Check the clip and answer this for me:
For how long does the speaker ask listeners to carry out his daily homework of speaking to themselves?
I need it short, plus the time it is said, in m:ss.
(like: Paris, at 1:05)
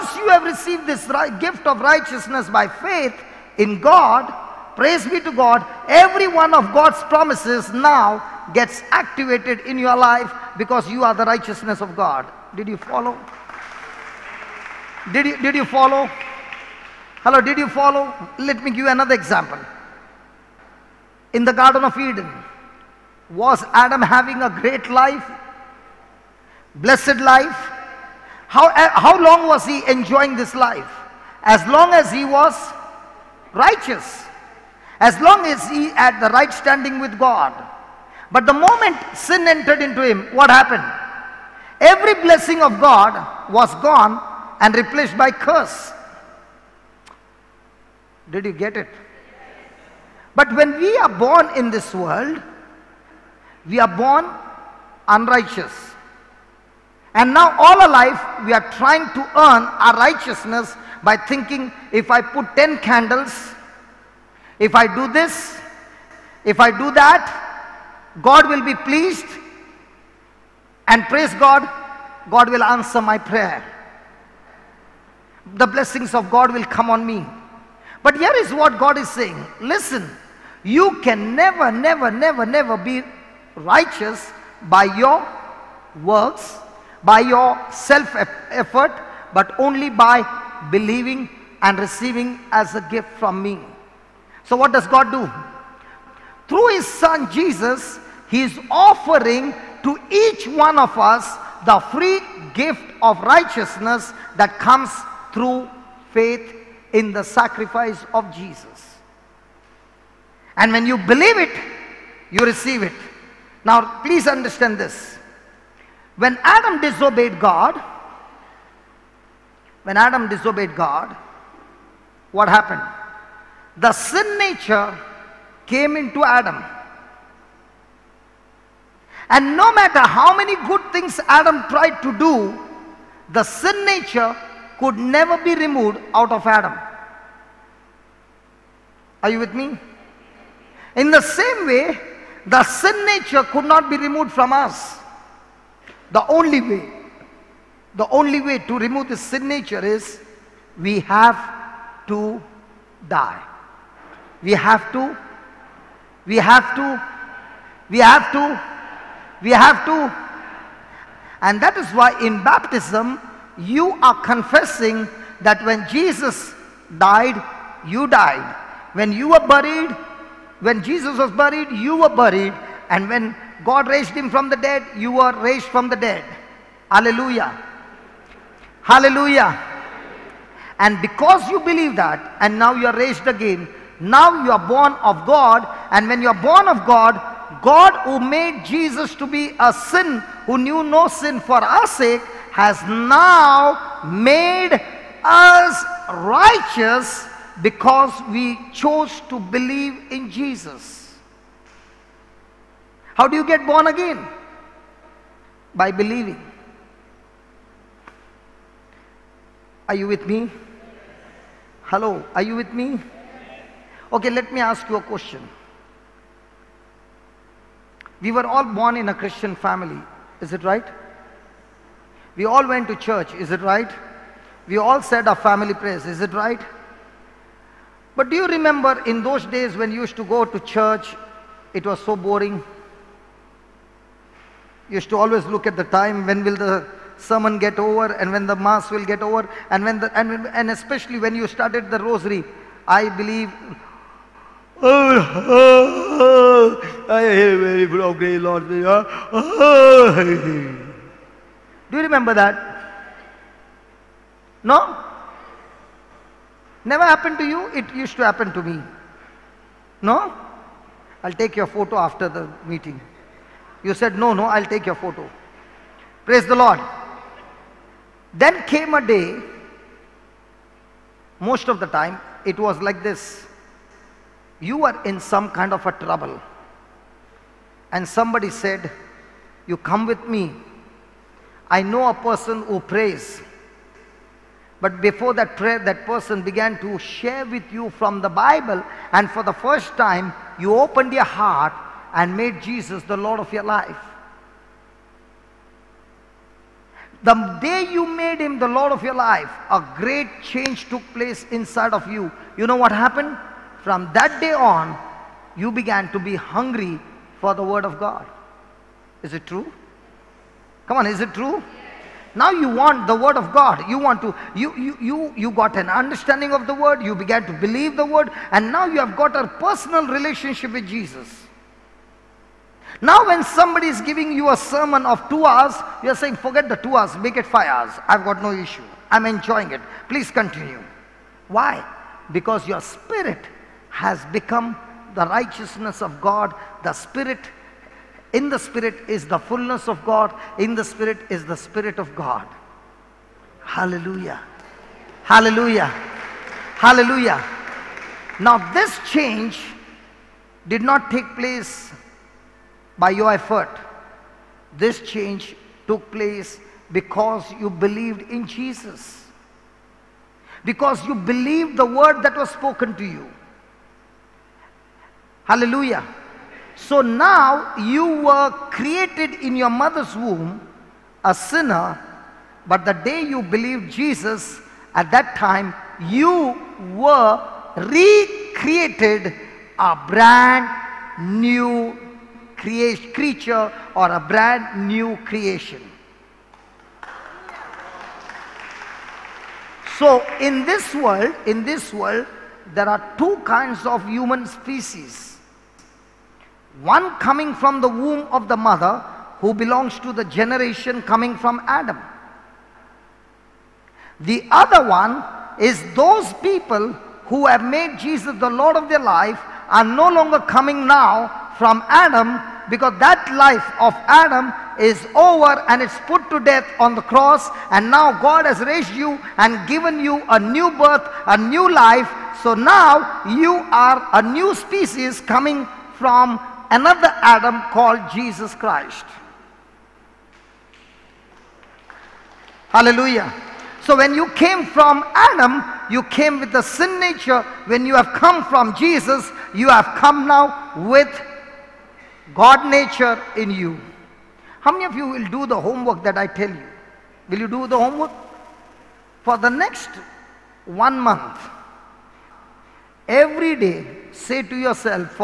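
1 month, at 7:30.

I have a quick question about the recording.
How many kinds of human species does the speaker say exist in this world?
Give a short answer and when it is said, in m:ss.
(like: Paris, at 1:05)
2, at 6:33.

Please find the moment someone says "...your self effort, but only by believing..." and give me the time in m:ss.
1:27.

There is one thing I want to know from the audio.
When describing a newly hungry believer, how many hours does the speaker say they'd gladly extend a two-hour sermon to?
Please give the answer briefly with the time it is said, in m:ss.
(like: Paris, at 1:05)
5, at 5:27.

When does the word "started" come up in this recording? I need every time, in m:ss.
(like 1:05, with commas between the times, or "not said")
4:01.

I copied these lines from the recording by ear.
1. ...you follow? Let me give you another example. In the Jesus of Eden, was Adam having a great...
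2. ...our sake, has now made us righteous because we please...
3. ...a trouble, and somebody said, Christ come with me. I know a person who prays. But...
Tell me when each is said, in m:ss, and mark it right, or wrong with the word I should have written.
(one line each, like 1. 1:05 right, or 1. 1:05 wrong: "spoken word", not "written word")
1. 0:17 wrong: "Garden", not "Jesus"
2. 3:11 wrong: "chose", not "please"
3. 4:35 wrong: "You", not "Christ".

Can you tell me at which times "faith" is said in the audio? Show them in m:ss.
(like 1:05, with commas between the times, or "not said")
0:02, 1:46.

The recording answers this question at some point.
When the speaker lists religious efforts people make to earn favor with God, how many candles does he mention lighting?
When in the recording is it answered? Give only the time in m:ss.
1:02.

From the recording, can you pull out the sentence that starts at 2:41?
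And that is why in baptism, you are confessing that when Jesus died, you died.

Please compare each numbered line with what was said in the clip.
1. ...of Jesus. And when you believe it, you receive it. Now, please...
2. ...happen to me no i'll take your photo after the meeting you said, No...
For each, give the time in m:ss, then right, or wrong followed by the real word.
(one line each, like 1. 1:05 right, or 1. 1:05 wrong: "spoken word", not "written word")
1. 1:48 right
2. 4:18 right.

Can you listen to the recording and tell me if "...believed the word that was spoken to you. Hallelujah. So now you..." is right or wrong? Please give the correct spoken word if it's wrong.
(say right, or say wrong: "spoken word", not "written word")
right.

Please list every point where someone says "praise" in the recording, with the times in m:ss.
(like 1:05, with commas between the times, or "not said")
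0:04, 1:11, 4:26.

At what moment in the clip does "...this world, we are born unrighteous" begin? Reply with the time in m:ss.
0:51.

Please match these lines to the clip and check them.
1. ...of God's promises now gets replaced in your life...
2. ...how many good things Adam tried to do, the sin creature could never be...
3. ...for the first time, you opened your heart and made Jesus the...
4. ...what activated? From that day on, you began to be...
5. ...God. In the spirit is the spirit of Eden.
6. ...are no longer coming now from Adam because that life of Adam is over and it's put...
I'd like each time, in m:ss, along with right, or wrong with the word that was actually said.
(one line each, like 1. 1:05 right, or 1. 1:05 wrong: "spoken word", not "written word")
1. 0:06 wrong: "activated", not "replaced"
2. 2:10 wrong: "nature", not "creature"
3. 4:49 right
4. 5:02 wrong: "happened", not "activated"
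5. 5:40 wrong: "God", not "Eden"
6. 6:49 right.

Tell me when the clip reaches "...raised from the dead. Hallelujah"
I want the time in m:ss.
2:55.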